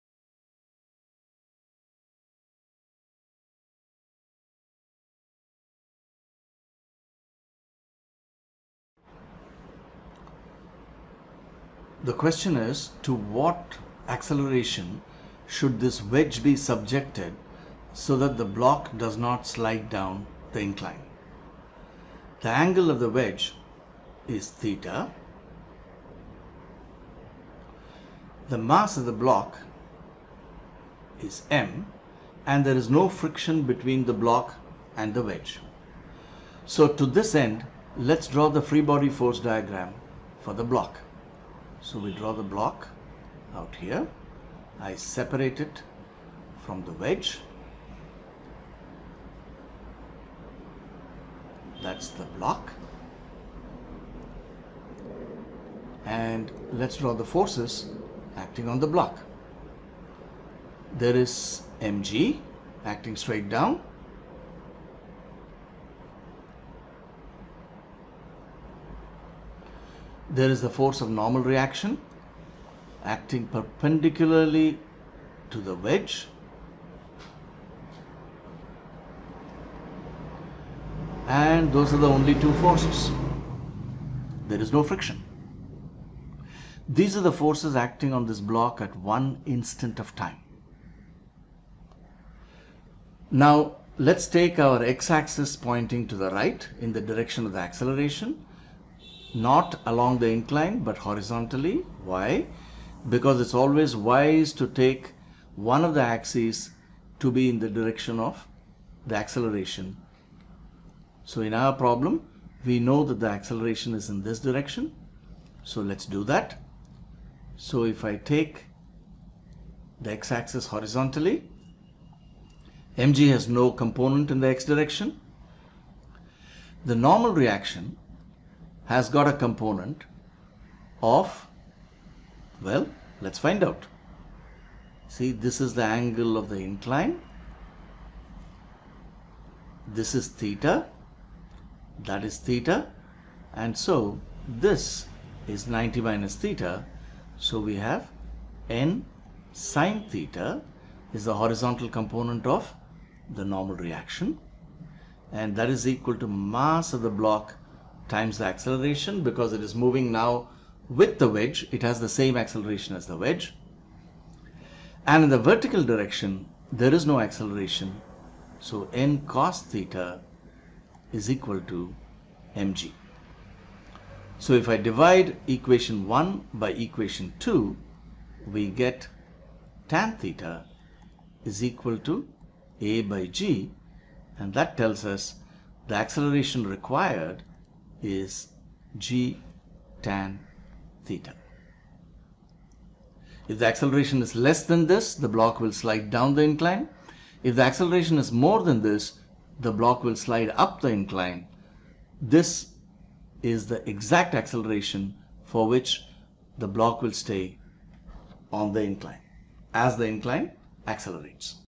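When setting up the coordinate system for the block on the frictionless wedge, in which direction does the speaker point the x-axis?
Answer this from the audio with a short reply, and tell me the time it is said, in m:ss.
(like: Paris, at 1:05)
To the right, at 1:35.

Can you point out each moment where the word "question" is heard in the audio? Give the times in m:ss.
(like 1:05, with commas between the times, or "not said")
0:12.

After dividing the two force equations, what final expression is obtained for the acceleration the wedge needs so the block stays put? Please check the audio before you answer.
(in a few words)
g tan theta.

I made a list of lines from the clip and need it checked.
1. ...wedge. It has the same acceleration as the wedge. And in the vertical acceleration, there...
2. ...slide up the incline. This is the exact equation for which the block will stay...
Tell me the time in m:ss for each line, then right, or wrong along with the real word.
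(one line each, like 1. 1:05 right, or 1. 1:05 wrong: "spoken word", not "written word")
1. 2:41 wrong: "direction", not "acceleration"
2. 3:20 wrong: "acceleration", not "equation".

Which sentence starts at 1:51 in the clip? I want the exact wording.
So in our problem, we know that the acceleration is in this direction.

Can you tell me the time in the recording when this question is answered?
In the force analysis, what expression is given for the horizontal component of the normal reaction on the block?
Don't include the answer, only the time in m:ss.
2:28.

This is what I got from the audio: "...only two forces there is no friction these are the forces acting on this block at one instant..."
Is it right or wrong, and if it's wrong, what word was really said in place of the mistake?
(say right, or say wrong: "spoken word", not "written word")
right.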